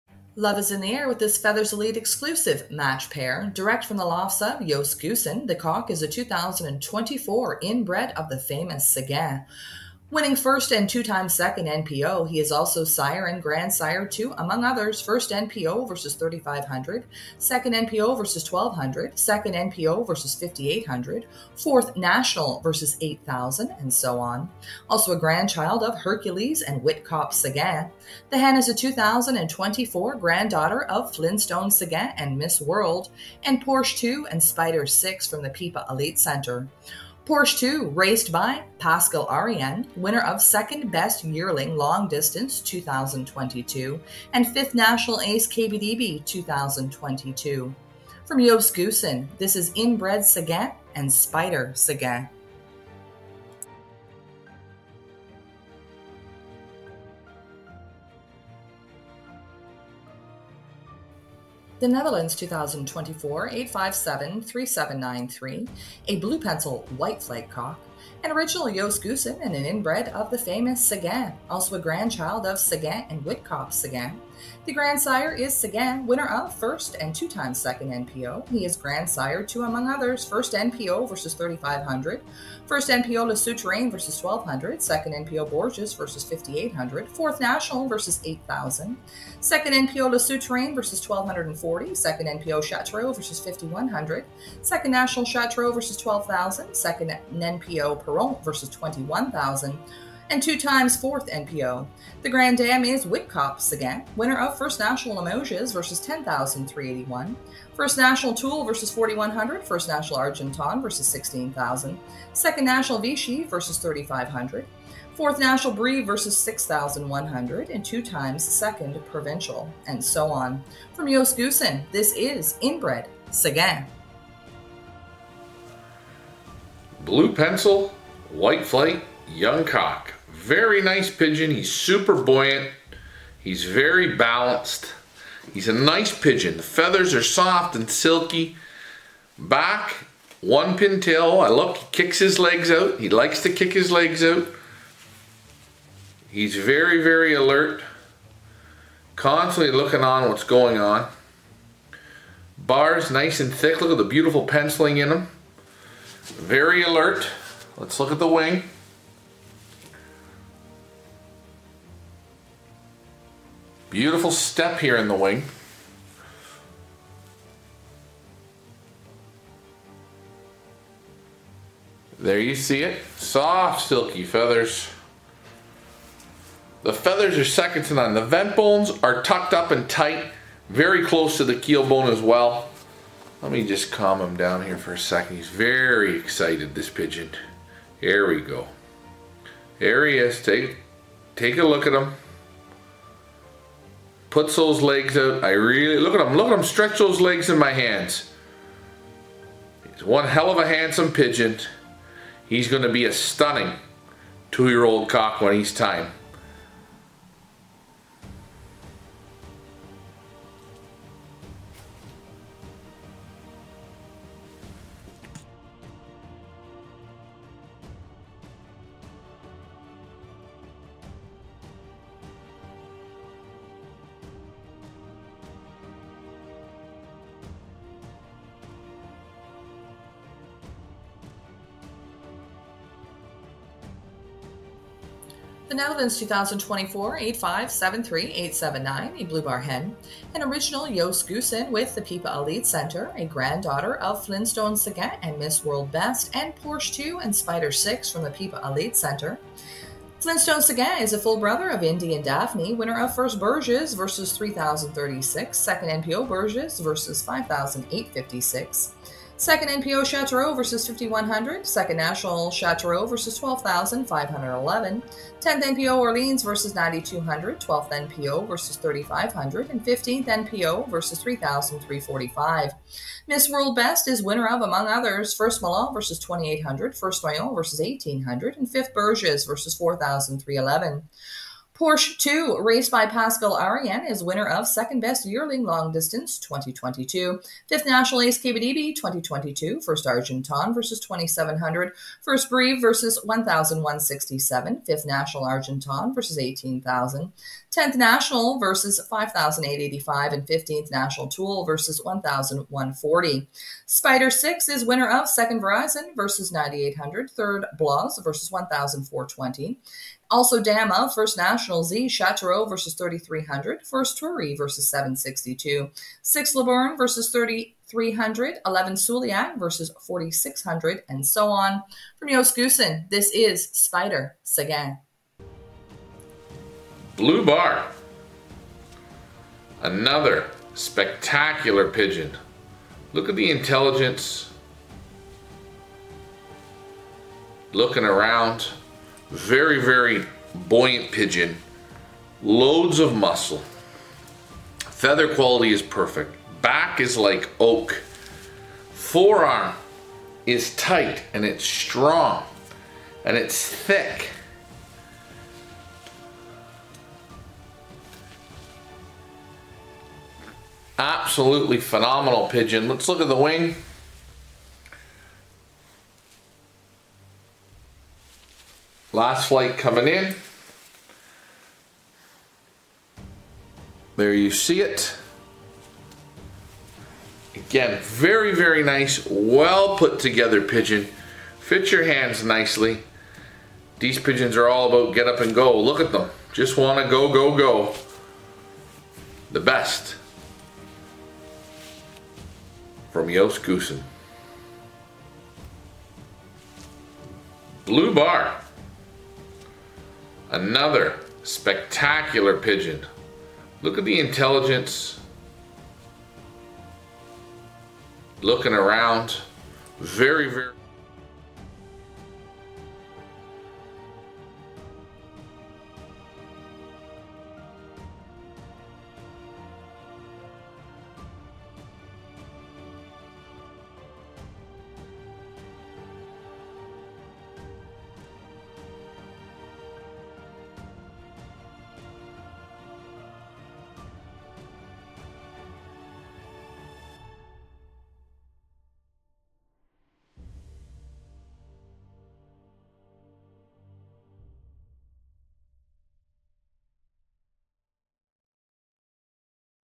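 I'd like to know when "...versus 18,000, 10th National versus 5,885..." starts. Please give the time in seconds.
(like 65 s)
296 s.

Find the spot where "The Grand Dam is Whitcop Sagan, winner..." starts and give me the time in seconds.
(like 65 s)
102 s.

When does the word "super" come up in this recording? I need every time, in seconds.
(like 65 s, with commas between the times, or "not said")
131 s.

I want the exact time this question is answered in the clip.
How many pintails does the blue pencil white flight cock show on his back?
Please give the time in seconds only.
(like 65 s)
140 s.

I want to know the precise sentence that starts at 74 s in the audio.
The grandsire is Sagan, winner of first and two times second NPO.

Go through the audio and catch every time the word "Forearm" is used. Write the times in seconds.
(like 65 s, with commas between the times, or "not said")
348 s.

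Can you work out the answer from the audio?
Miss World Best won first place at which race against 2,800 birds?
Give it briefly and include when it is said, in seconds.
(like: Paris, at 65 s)
Milan, at 275 s.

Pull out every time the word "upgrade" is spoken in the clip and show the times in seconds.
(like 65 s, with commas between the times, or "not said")
not said.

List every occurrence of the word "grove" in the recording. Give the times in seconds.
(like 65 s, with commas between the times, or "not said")
not said.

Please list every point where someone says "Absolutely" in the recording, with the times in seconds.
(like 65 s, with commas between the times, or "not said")
360 s.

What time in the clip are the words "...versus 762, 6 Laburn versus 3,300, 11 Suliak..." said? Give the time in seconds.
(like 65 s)
314 s.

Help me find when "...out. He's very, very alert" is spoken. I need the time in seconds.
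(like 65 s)
144 s.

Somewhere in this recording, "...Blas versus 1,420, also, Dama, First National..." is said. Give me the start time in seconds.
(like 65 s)
307 s.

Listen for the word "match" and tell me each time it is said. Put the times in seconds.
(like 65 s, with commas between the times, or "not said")
2 s.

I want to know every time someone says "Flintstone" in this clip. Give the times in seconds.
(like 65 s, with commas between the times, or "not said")
31 s, 244 s, 250 s.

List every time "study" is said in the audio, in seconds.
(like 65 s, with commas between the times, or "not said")
not said.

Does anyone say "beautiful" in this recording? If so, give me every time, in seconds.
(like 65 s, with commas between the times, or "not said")
154 s, 163 s.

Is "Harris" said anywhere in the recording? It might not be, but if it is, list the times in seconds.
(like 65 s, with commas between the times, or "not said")
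not said.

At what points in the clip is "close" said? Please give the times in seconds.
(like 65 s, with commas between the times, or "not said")
181 s.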